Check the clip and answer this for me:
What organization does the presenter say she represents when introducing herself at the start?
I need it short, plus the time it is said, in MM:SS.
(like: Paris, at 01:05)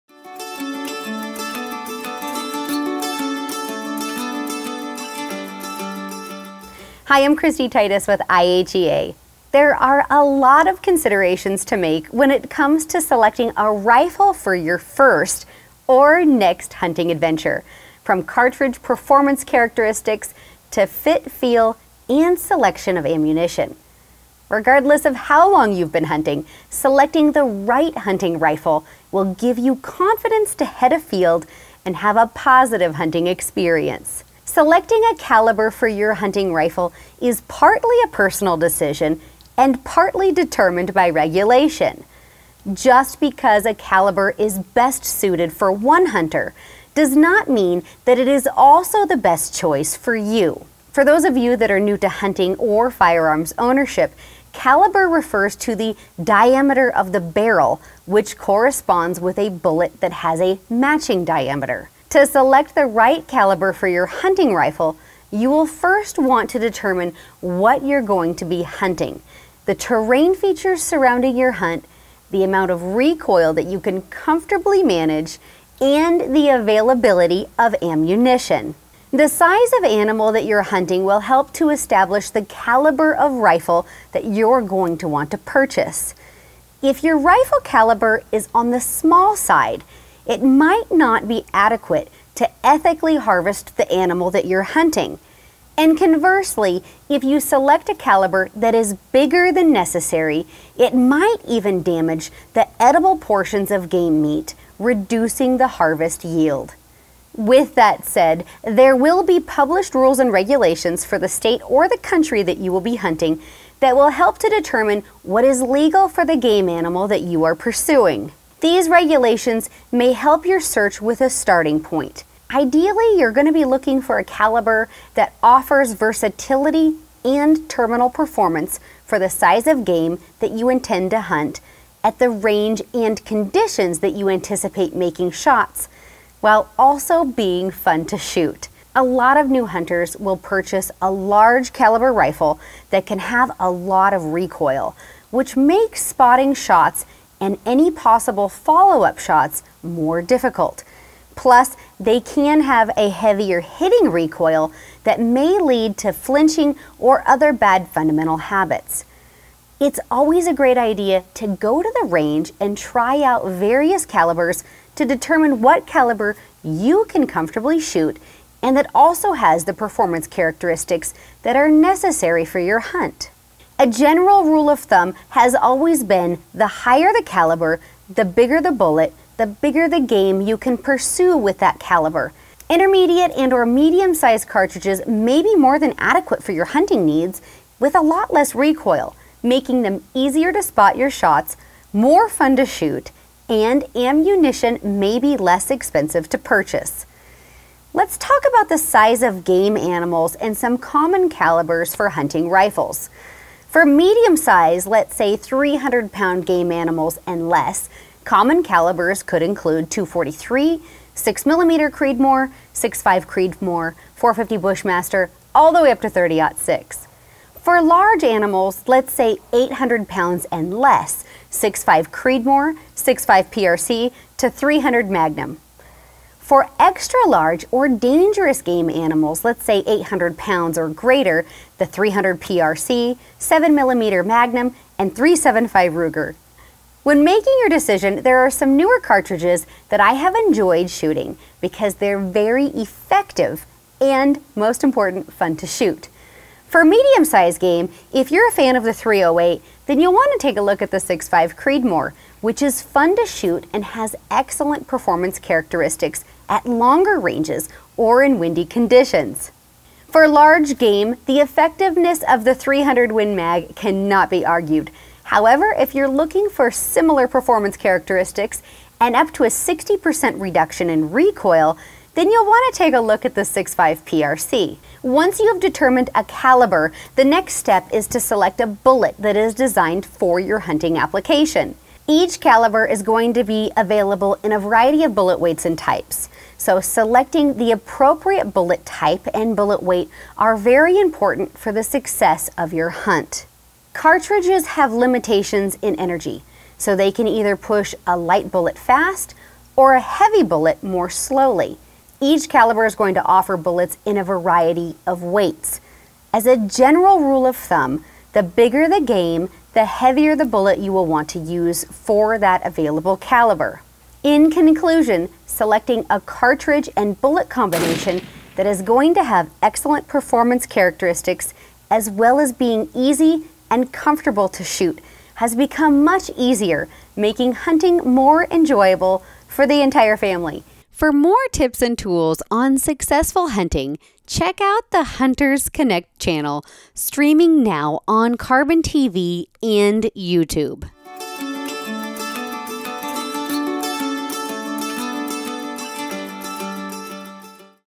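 IHEA, at 00:08.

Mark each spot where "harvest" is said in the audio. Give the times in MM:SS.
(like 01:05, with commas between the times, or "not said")
01:33, 01:45.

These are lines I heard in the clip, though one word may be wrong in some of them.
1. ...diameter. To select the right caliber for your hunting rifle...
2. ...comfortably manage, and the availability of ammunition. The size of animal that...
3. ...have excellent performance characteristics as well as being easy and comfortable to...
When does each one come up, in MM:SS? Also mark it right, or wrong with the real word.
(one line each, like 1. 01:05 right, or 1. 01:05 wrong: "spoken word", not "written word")
1. 01:01 right
2. 01:14 right
3. 05:19 right.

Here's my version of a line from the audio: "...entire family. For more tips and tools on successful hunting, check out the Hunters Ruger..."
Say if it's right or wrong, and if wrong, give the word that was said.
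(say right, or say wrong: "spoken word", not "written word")
wrong: "Connect", not "Ruger".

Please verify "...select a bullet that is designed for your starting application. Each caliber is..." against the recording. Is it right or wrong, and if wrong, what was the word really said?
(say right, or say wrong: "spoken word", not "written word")
wrong: "hunting", not "starting".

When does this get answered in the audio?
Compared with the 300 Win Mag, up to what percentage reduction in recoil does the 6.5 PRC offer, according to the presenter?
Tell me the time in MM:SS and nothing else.
04:29.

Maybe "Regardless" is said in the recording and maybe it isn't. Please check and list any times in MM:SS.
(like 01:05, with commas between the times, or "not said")
00:24.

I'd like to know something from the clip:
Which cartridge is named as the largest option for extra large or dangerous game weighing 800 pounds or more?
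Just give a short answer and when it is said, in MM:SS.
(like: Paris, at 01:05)
375 Ruger, at 03:55.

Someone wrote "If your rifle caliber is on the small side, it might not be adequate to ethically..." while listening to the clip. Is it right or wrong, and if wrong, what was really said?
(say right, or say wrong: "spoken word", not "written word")
right.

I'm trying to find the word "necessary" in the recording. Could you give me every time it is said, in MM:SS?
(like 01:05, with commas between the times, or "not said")
01:39, 02:51.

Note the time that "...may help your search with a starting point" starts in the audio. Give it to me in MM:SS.
01:59.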